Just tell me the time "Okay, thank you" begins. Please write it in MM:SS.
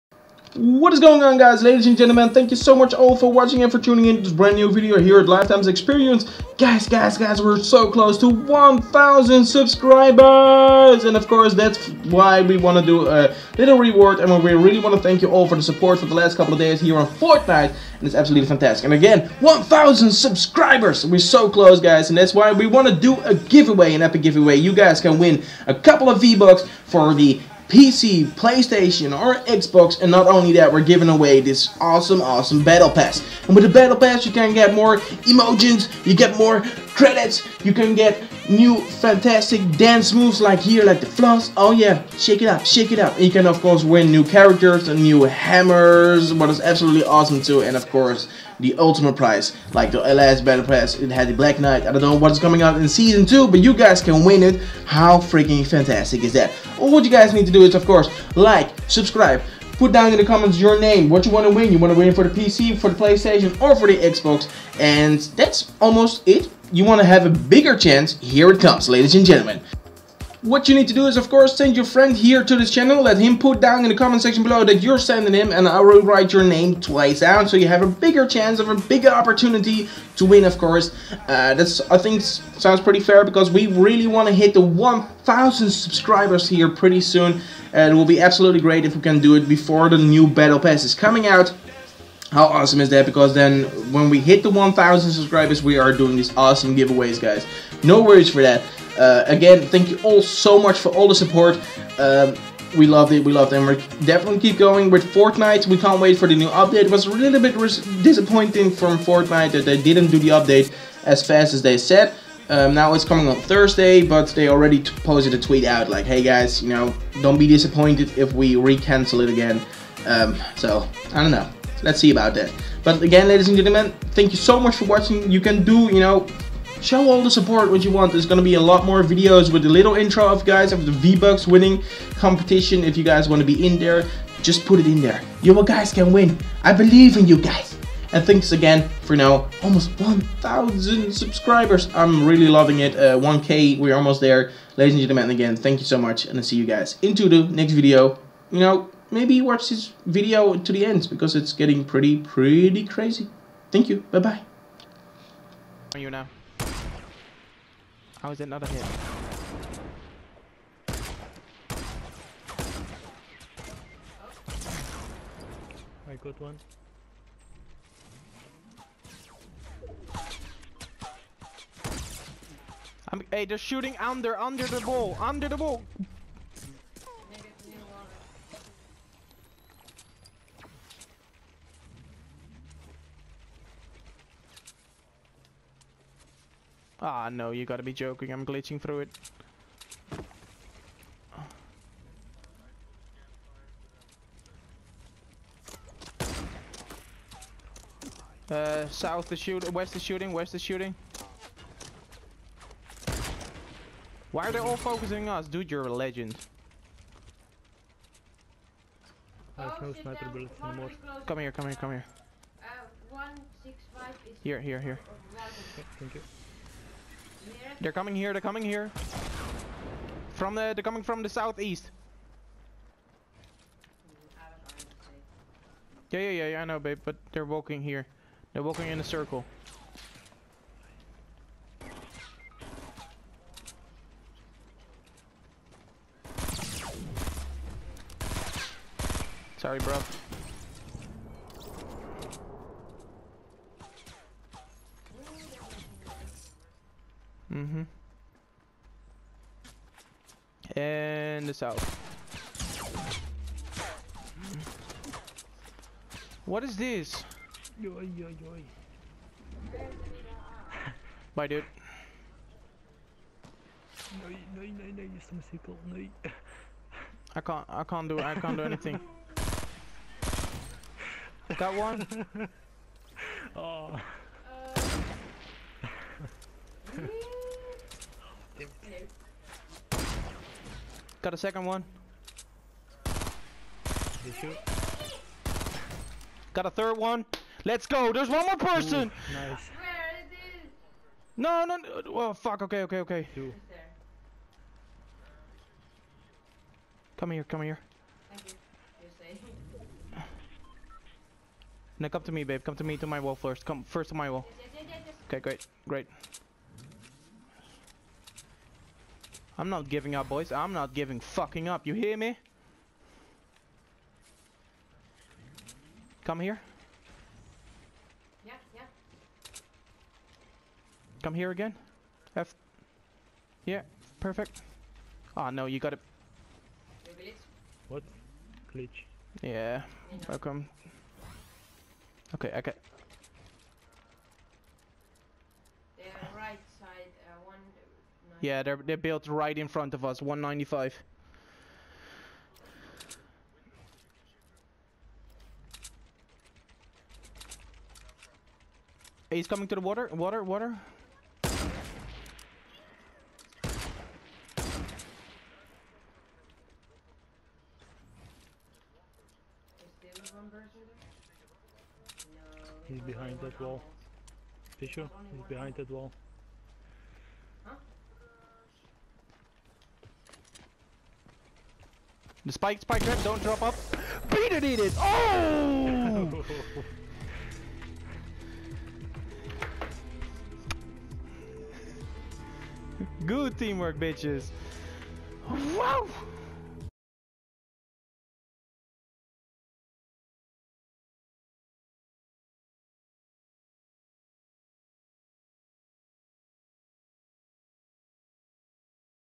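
03:35.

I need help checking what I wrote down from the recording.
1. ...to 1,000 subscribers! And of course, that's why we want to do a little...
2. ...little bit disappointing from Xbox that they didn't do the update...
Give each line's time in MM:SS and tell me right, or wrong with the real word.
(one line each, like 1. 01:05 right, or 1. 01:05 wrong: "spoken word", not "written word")
1. 00:08 right
2. 01:47 wrong: "Fortnite", not "Xbox".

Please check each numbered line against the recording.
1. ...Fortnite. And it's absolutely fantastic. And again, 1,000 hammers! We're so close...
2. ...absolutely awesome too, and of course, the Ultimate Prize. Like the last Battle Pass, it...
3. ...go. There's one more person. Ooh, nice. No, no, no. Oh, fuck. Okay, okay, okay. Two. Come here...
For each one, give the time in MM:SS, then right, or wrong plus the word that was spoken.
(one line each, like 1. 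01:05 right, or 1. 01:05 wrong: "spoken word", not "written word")
1. 00:17 wrong: "subscribers", not "hammers"
2. 00:46 right
3. 04:47 right.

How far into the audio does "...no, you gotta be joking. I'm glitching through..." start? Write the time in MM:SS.
03:07.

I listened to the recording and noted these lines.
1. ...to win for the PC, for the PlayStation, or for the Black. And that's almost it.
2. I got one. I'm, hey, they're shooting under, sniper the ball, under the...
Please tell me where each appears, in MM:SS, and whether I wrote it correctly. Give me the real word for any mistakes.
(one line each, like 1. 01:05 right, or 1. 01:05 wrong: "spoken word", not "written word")
1. 01:01 wrong: "Xbox", not "Black"
2. 02:46 wrong: "under", not "sniper".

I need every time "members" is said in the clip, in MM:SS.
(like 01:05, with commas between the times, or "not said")
not said.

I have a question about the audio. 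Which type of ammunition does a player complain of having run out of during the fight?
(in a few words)
sniper bullets.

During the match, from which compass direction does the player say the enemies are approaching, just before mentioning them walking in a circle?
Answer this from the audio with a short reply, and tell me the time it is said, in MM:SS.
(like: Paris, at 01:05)
southeast, at 03:41.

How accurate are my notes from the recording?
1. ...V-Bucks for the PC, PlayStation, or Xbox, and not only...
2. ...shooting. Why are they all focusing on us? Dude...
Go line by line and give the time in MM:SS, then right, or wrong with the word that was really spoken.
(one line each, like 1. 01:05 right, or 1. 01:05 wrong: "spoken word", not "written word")
1. 00:26 right
2. 03:20 right.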